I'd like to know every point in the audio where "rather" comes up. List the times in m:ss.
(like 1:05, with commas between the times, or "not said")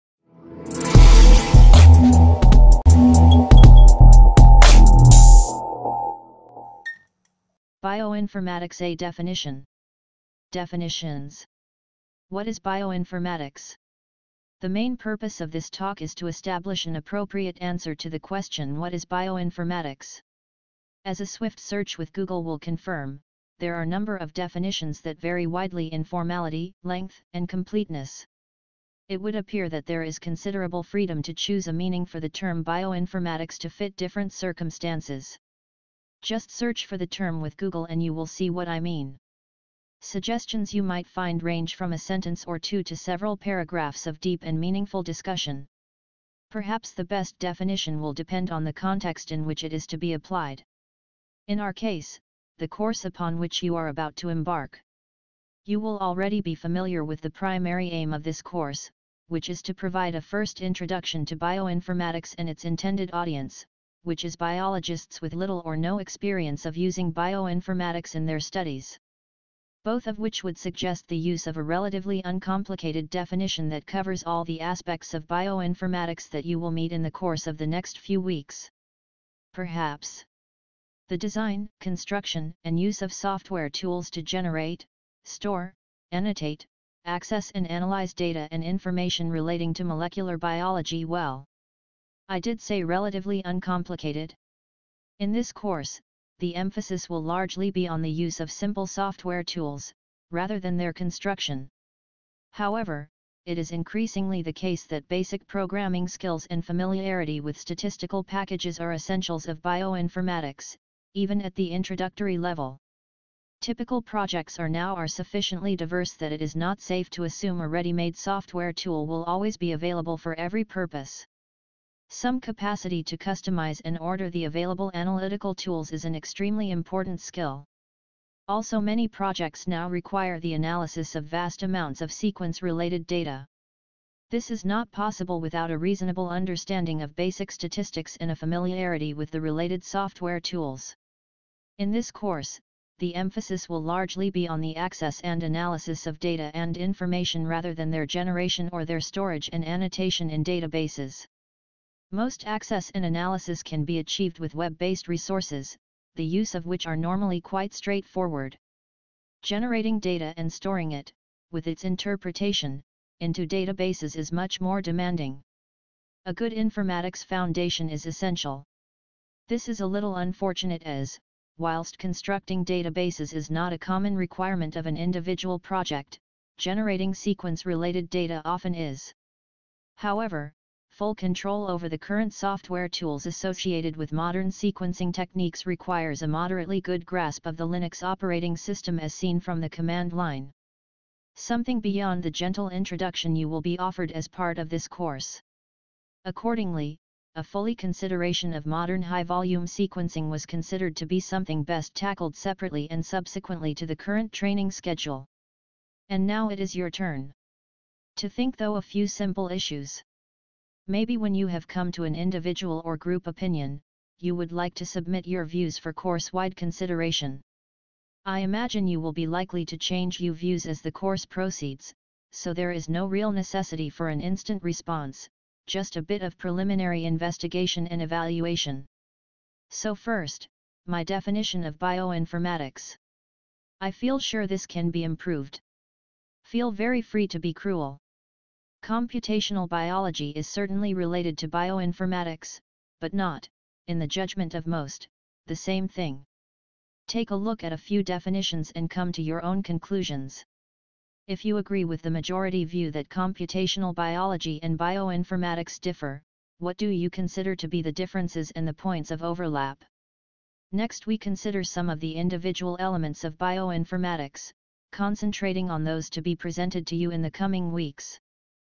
1:40, 2:27.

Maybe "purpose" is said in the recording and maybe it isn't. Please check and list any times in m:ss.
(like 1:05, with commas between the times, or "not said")
0:14, 2:00.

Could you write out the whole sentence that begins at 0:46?
Perhaps the best definition will depend on the context in which it is to be applied.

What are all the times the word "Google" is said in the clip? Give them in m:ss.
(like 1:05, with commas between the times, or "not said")
0:22, 0:37.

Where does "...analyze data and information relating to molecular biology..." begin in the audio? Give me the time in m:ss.
1:27.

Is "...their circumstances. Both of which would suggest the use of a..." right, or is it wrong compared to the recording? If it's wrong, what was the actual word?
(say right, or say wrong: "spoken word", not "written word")
wrong: "studies", not "circumstances".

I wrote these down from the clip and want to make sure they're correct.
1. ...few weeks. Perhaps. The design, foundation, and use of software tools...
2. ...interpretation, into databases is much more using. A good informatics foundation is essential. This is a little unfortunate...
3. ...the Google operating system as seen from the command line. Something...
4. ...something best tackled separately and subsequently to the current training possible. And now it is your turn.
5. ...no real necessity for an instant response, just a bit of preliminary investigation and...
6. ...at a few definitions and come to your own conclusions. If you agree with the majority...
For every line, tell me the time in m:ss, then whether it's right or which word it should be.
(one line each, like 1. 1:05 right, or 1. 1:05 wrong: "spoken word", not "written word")
1. 1:17 wrong: "construction", not "foundation"
2. 2:41 wrong: "demanding", not "using"
3. 3:07 wrong: "Linux", not "Google"
4. 3:21 wrong: "schedule", not "possible"
5. 3:42 right
6. 4:07 right.